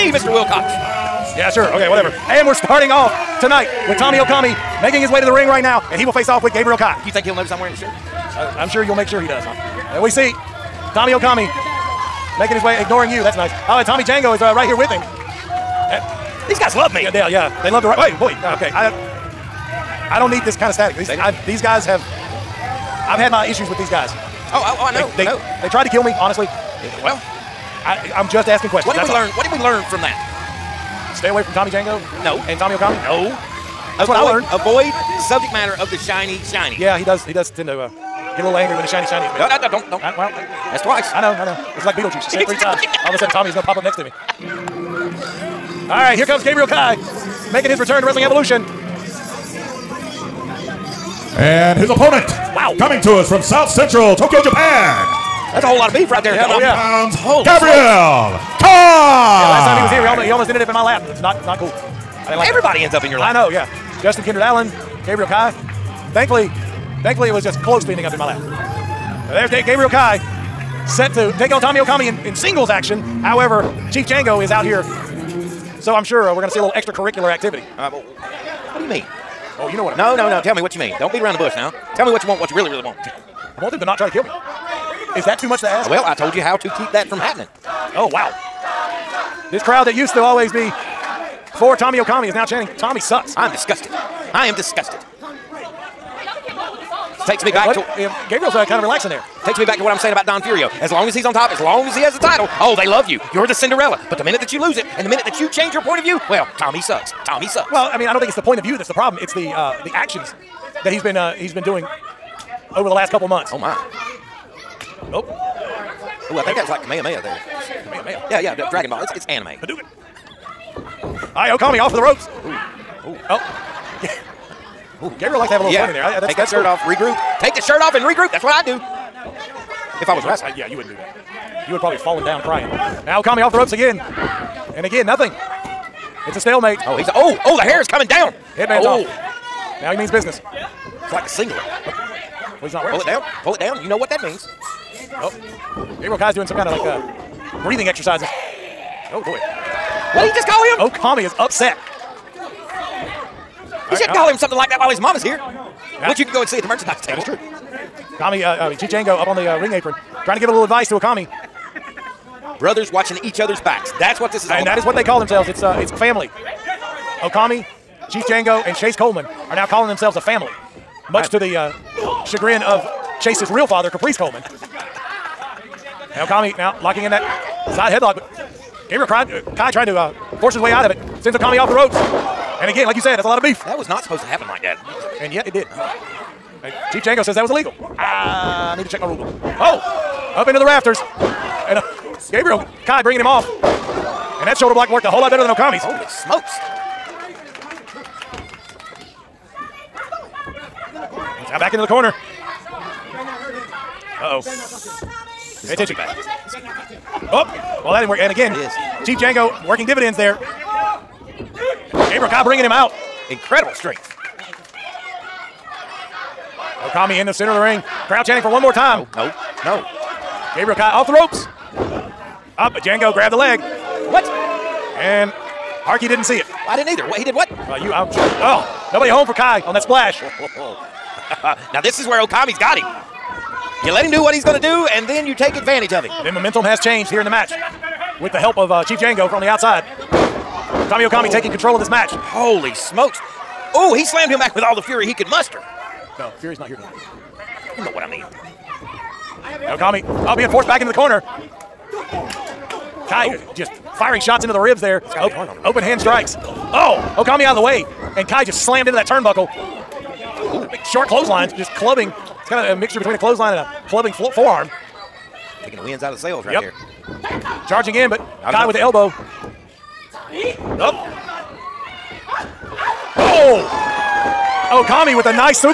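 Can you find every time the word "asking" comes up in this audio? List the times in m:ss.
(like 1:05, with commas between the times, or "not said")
0:28.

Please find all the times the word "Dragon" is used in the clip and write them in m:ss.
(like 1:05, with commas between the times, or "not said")
1:58.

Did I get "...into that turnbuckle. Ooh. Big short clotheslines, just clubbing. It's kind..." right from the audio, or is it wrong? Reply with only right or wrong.
right.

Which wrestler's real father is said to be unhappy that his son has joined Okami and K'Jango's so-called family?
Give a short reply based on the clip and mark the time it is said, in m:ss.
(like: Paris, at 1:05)
Caprice Coleman, at 2:53.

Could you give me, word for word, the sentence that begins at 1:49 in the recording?
It's the uh, the actions that he's been uh, he's been doing over the last couple of months.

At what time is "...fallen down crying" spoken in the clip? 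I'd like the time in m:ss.
2:11.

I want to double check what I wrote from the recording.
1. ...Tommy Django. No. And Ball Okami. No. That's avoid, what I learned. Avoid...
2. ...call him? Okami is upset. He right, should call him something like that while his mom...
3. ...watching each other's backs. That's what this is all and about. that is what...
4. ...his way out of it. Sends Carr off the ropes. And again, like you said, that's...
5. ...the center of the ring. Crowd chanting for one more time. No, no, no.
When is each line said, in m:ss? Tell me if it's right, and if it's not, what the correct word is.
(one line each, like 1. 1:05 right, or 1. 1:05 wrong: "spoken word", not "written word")
1. 0:31 wrong: "Tommy", not "Ball"
2. 2:30 right
3. 2:42 right
4. 3:00 wrong: "Okami", not "Carr"
5. 3:37 right.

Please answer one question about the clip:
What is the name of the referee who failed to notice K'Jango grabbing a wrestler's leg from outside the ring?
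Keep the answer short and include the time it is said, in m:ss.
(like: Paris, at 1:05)
Harkey, at 3:45.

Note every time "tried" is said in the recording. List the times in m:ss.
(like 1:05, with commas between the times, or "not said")
0:25.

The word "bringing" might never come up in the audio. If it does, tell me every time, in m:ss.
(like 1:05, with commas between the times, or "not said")
3:13, 3:32.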